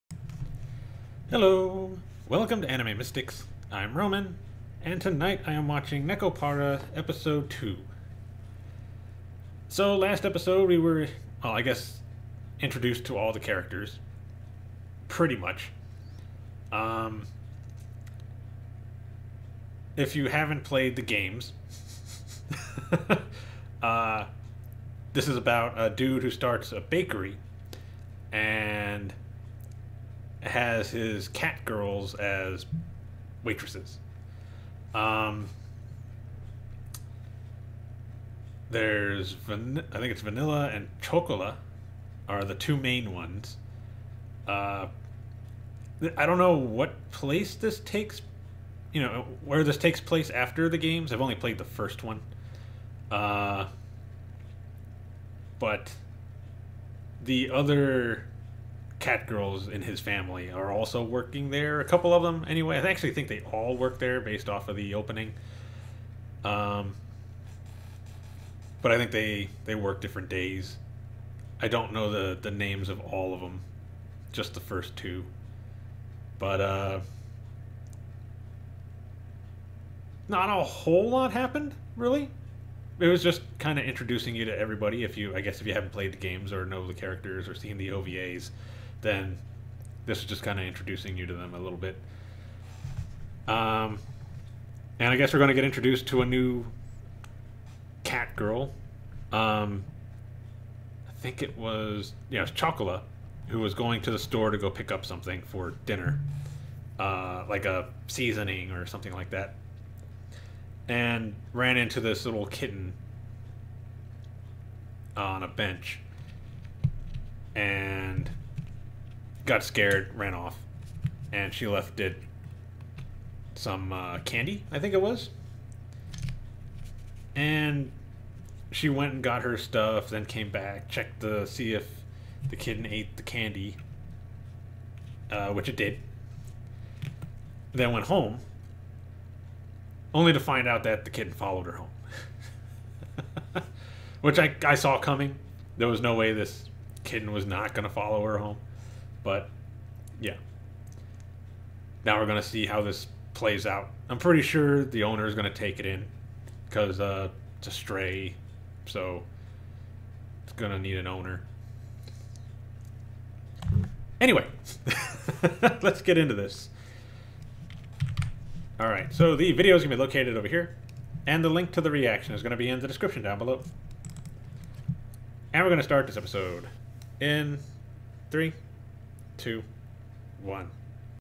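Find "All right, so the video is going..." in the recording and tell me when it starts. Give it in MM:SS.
02:48.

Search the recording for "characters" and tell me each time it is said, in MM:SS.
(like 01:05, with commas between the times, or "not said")
00:13, 01:26.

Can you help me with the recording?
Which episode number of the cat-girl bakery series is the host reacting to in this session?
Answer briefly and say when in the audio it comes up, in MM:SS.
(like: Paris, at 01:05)
Episode 2, at 00:06.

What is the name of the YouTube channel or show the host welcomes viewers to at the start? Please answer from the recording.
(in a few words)
Anime Mystics.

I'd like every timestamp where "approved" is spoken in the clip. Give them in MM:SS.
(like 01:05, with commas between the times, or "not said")
not said.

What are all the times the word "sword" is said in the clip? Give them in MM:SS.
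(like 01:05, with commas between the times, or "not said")
not said.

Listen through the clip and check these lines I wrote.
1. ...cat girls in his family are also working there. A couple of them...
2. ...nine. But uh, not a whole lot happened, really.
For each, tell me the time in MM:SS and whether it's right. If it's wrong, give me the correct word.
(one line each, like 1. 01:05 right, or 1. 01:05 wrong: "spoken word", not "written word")
1. 00:59 right
2. 01:14 wrong: "two", not "nine".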